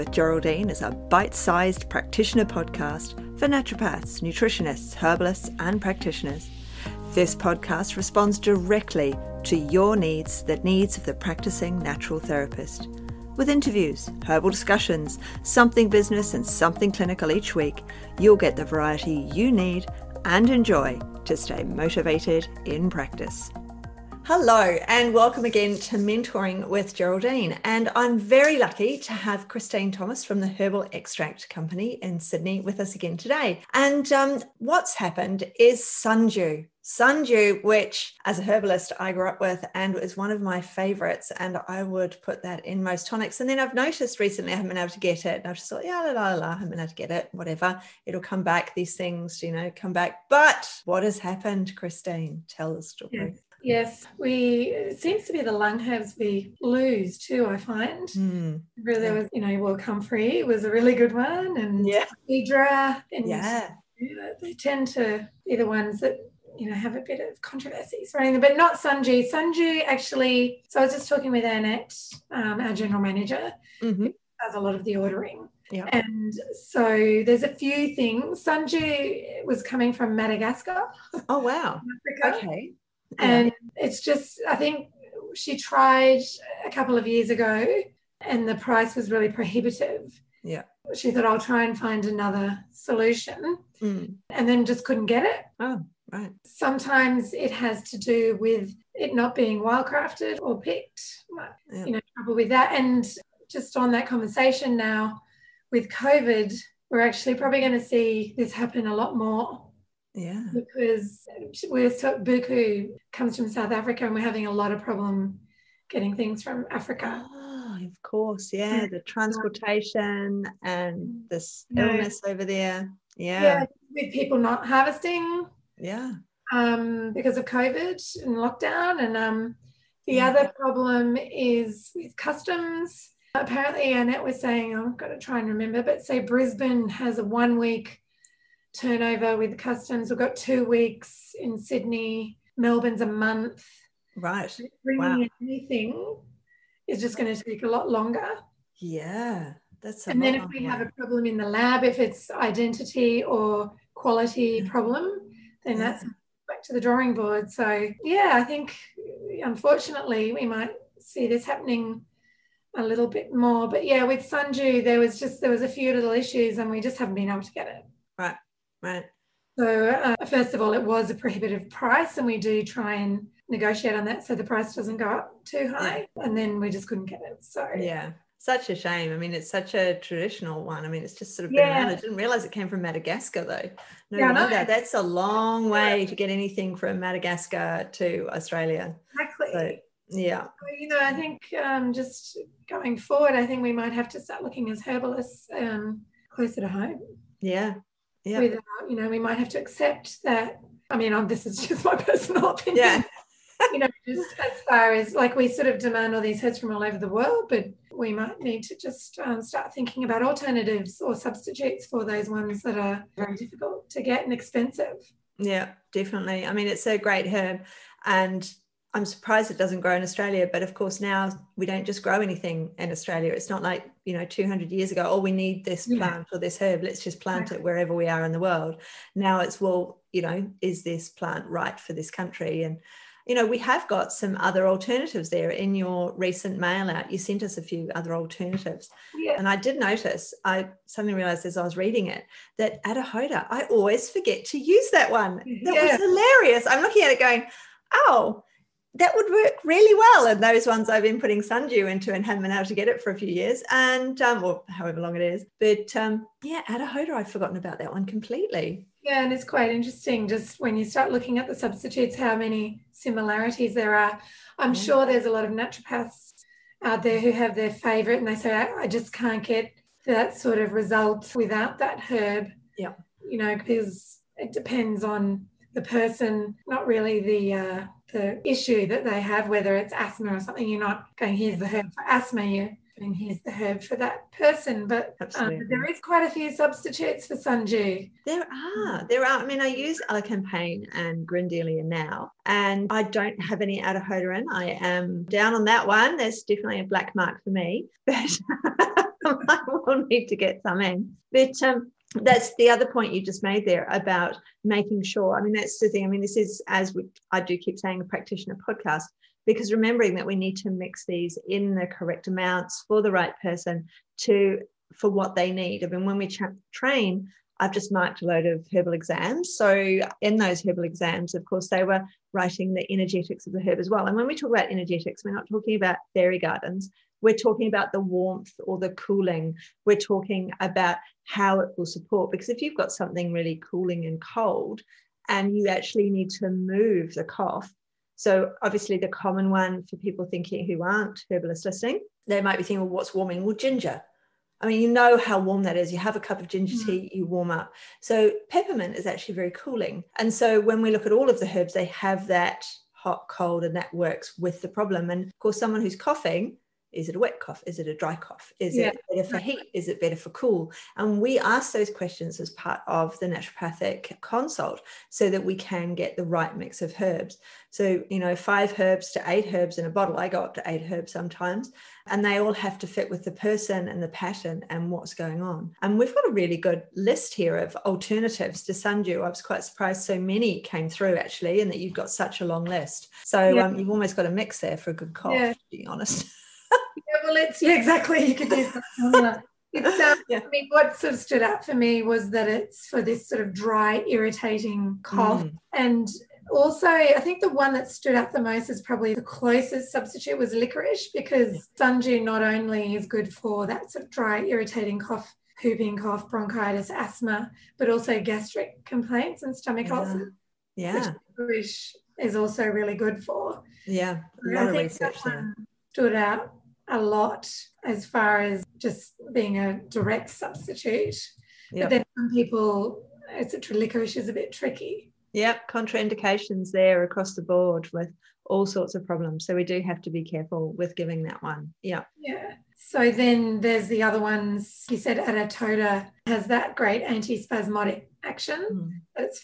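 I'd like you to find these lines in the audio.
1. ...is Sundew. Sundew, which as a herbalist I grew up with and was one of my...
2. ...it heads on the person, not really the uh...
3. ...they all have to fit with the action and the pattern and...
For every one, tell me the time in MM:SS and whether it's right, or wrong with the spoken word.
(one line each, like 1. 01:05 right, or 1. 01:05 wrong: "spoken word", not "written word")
1. 00:35 right
2. 04:34 wrong: "depends", not "heads"
3. 06:12 wrong: "person", not "action".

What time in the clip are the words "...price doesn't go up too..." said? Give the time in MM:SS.
02:54.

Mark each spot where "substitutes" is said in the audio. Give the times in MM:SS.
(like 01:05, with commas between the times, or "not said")
03:31, 04:21, 04:46, 06:39, 07:00.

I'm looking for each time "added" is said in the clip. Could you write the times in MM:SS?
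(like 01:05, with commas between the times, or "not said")
not said.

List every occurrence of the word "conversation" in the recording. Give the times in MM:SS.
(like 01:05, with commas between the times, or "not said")
01:44.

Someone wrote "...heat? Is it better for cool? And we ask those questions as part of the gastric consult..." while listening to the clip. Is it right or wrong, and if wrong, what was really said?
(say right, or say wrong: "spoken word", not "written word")
wrong: "naturopathic", not "gastric".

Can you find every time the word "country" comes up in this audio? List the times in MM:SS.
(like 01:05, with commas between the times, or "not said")
03:52.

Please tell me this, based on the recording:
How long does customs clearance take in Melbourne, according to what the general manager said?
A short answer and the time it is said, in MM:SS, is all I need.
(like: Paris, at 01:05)
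a month, at 02:23.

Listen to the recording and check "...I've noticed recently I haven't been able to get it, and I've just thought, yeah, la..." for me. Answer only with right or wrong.
right.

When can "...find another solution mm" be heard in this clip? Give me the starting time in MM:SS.
01:31.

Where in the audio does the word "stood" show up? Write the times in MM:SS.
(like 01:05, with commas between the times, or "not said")
06:31, 06:37, 06:55.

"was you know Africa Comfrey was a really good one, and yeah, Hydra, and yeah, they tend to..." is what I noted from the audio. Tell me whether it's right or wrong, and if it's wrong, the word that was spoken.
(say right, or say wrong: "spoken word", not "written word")
wrong: "Will", not "Africa".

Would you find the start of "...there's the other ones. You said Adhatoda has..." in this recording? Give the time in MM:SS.
07:13.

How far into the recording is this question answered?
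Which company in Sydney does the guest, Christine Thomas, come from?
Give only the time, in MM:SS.
00:30.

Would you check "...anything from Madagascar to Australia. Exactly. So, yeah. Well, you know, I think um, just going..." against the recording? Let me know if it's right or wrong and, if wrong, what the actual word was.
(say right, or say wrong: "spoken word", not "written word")
right.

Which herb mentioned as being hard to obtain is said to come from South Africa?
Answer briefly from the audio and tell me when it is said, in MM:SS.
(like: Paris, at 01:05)
Buchu, at 01:52.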